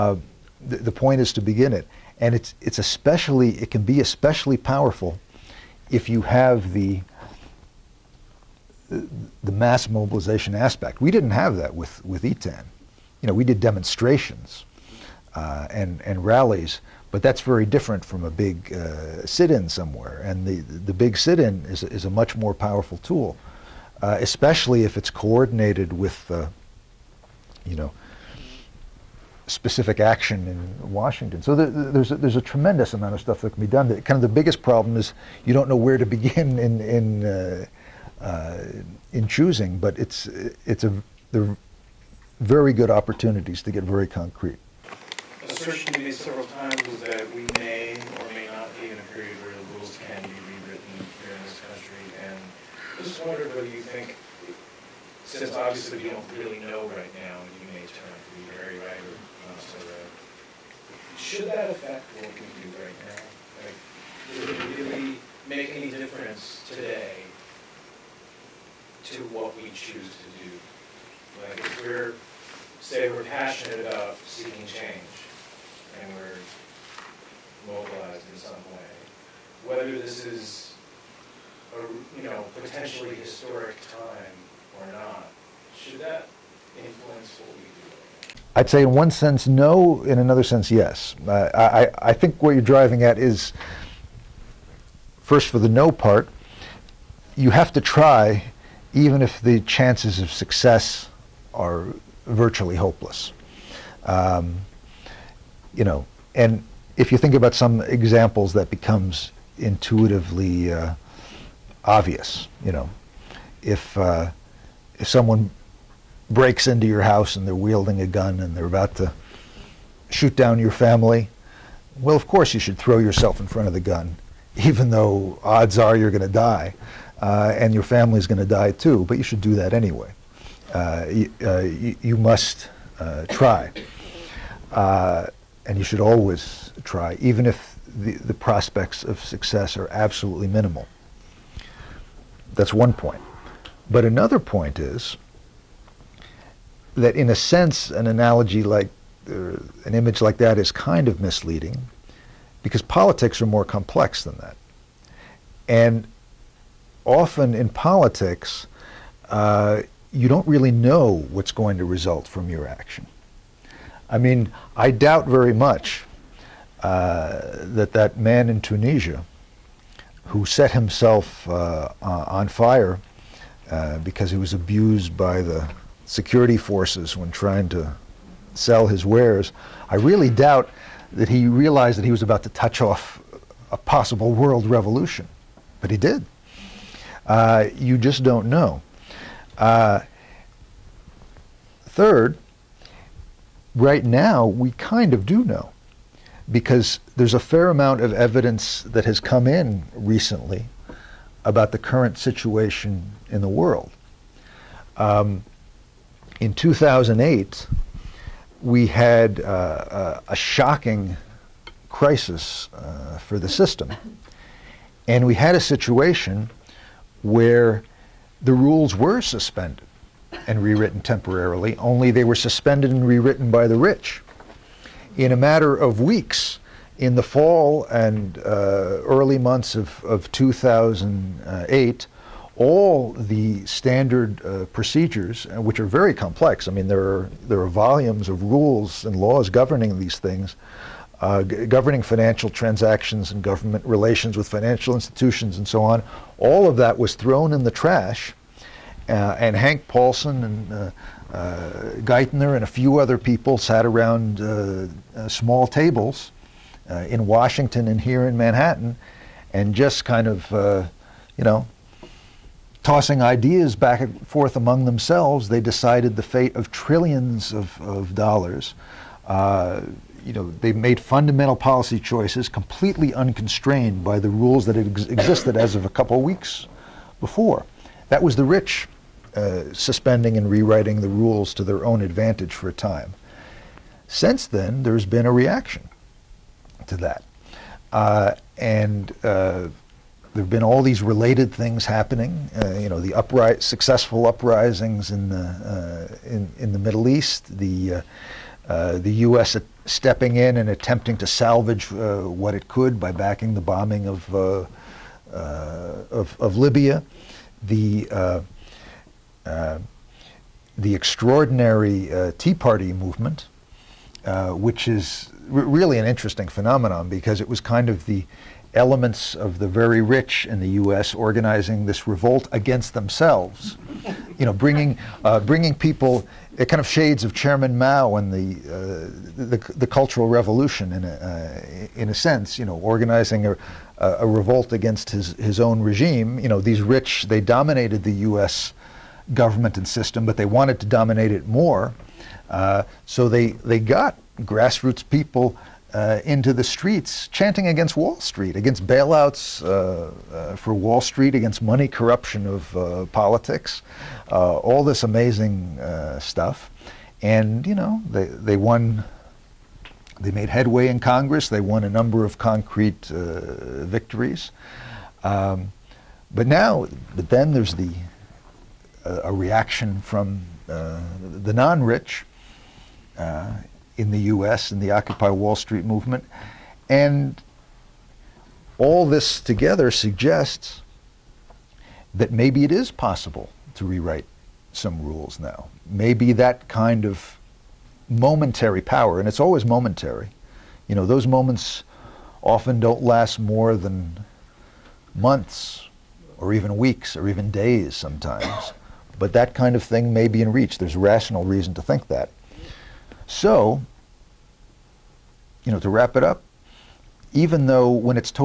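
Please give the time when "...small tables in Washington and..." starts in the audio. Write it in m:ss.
4:15.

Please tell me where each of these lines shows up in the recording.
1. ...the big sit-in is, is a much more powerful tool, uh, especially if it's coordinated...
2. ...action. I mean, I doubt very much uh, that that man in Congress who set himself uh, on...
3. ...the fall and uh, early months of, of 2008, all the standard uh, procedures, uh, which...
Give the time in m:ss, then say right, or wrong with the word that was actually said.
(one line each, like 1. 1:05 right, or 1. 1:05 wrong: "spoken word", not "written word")
1. 0:20 right
2. 2:42 wrong: "Tunisia", not "Congress"
3. 3:47 right.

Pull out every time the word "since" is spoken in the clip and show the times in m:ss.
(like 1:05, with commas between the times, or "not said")
0:55, 4:44.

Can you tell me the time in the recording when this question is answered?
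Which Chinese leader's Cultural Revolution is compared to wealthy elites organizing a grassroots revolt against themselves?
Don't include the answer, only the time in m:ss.
5:27.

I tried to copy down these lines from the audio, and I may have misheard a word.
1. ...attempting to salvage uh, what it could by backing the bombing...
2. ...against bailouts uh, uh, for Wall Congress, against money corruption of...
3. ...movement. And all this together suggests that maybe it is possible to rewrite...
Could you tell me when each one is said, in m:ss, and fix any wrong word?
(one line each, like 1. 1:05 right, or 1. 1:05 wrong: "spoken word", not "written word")
1. 5:00 right
2. 5:48 wrong: "Street", not "Congress"
3. 6:15 right.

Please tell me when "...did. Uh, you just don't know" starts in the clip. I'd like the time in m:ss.
3:05.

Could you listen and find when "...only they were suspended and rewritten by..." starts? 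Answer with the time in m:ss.
3:41.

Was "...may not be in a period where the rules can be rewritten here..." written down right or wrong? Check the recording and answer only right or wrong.
right.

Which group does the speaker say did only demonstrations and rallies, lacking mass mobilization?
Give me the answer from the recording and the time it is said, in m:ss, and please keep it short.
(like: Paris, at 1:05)
ETAN, at 0:12.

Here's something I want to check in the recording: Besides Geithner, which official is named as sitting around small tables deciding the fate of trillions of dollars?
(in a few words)
Hank Paulson.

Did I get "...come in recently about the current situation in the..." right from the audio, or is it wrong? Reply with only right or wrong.
right.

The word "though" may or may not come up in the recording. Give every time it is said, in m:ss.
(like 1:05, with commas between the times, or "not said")
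2:04, 6:47.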